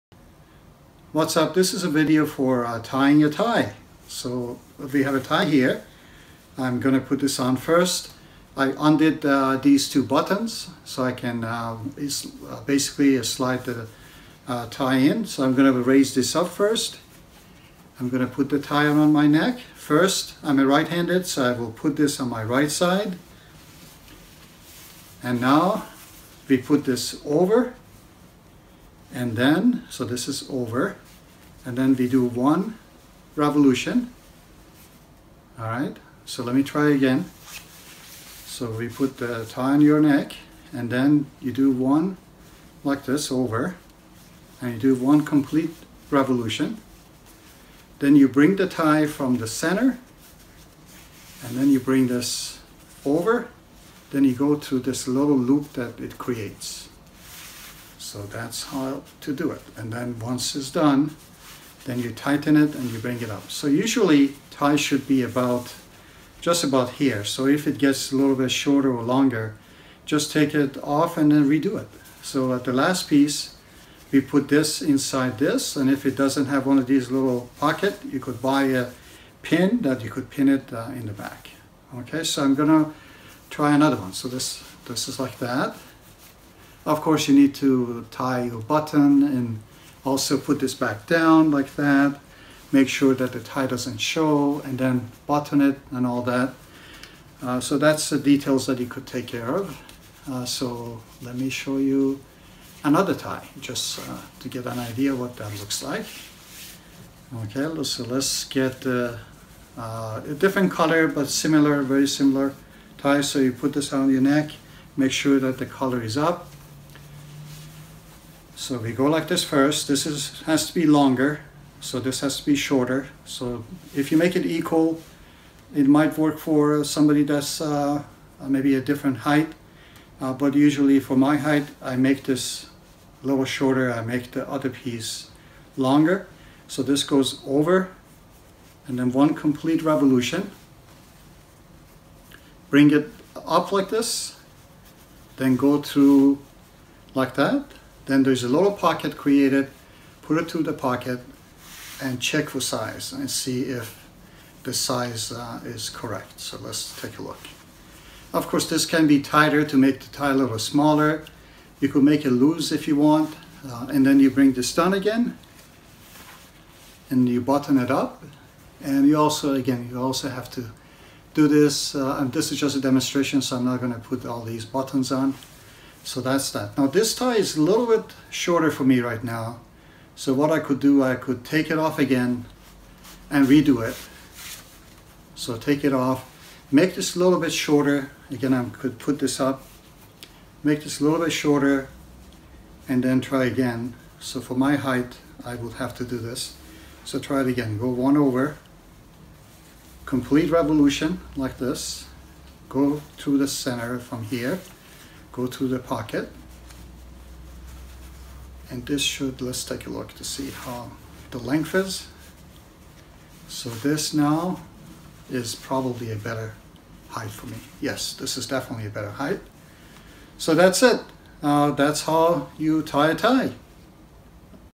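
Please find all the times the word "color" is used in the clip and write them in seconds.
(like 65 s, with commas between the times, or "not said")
110 s, 115 s.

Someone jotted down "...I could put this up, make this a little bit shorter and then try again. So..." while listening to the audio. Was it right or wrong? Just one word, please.
right.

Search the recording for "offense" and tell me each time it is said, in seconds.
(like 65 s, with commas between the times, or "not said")
not said.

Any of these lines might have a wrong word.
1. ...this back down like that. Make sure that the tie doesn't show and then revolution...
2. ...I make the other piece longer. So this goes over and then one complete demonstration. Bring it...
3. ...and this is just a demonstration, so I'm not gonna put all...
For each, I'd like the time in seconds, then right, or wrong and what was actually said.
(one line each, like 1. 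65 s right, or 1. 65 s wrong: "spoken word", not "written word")
1. 90 s wrong: "button", not "revolution"
2. 133 s wrong: "revolution", not "demonstration"
3. 172 s right.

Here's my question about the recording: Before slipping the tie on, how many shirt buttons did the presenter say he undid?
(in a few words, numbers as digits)
2.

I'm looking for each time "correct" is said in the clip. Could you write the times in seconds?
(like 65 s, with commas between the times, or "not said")
155 s.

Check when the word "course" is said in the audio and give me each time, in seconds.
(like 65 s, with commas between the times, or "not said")
87 s, 158 s.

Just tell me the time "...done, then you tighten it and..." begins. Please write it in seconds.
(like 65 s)
60 s.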